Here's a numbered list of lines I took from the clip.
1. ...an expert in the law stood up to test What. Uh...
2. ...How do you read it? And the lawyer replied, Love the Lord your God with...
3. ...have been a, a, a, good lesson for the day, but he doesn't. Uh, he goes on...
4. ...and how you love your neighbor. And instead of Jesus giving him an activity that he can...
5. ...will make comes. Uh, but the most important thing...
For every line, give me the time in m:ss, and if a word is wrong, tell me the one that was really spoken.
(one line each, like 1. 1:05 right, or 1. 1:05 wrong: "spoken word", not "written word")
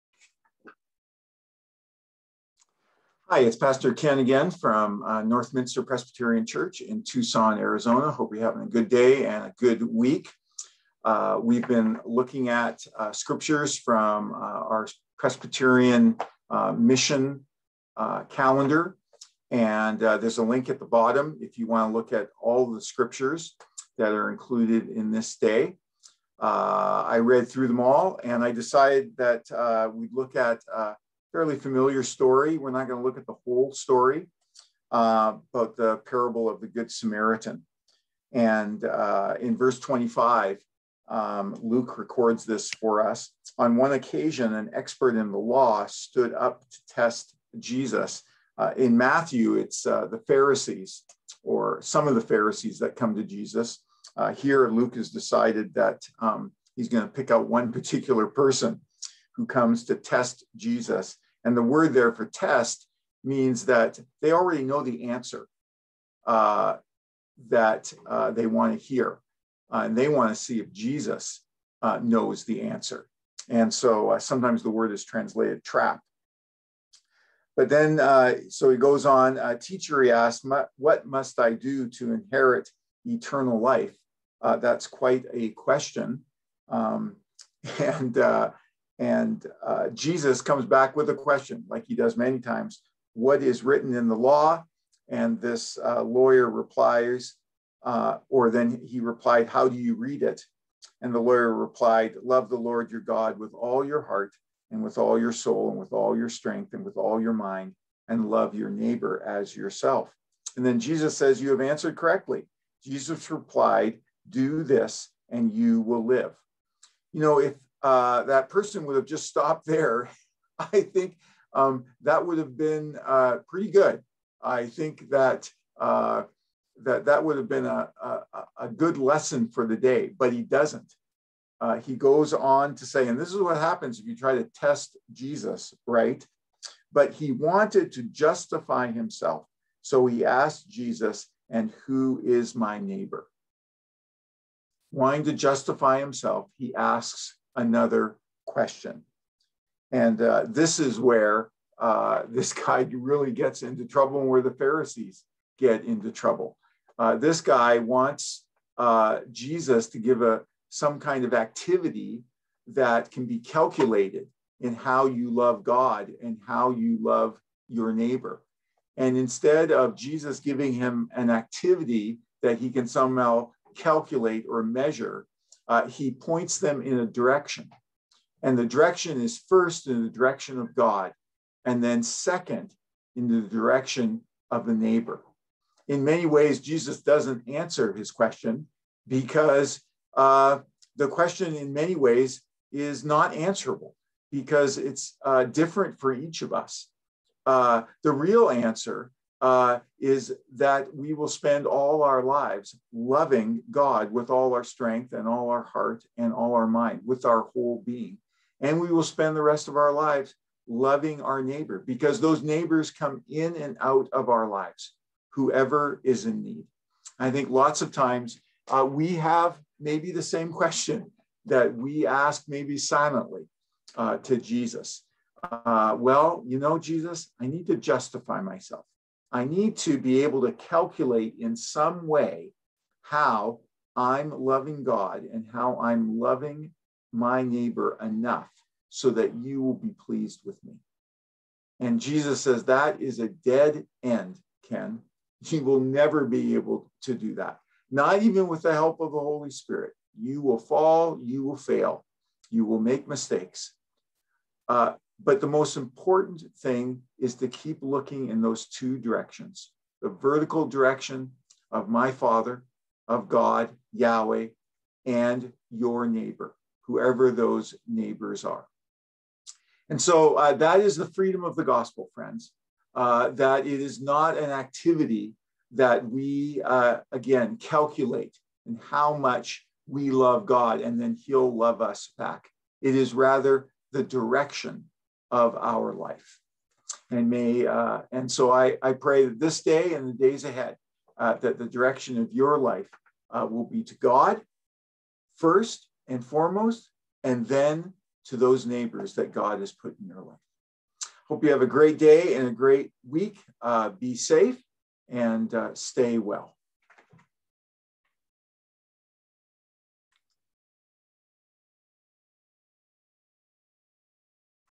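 1. 0:44 wrong: "Jesus", not "What"
2. 1:39 right
3. 2:07 right
4. 2:46 right
5. 4:12 wrong: "mistakes", not "comes".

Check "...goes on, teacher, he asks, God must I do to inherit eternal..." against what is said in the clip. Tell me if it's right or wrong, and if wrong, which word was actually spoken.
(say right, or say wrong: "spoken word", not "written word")
wrong: "What", not "God".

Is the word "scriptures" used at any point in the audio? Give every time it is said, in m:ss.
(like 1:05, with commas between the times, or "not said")
0:13, 0:22.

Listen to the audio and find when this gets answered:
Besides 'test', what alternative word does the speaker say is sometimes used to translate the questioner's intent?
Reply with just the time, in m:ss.
1:15.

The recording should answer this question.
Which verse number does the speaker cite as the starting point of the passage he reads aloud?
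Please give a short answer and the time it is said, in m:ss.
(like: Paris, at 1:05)
25, at 0:39.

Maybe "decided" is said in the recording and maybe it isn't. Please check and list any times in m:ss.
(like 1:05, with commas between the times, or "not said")
0:28, 0:55.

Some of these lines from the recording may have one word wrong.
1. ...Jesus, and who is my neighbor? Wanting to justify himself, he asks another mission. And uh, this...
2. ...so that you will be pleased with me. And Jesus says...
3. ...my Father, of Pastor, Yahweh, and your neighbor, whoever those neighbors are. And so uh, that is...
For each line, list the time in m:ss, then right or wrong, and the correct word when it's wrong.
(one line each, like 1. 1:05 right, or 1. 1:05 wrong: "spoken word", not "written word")
1. 2:20 wrong: "question", not "mission"
2. 3:58 right
3. 4:21 wrong: "God", not "Pastor".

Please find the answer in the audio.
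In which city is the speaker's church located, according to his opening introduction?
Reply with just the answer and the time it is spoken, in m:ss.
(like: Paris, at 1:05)
Tucson, at 0:07.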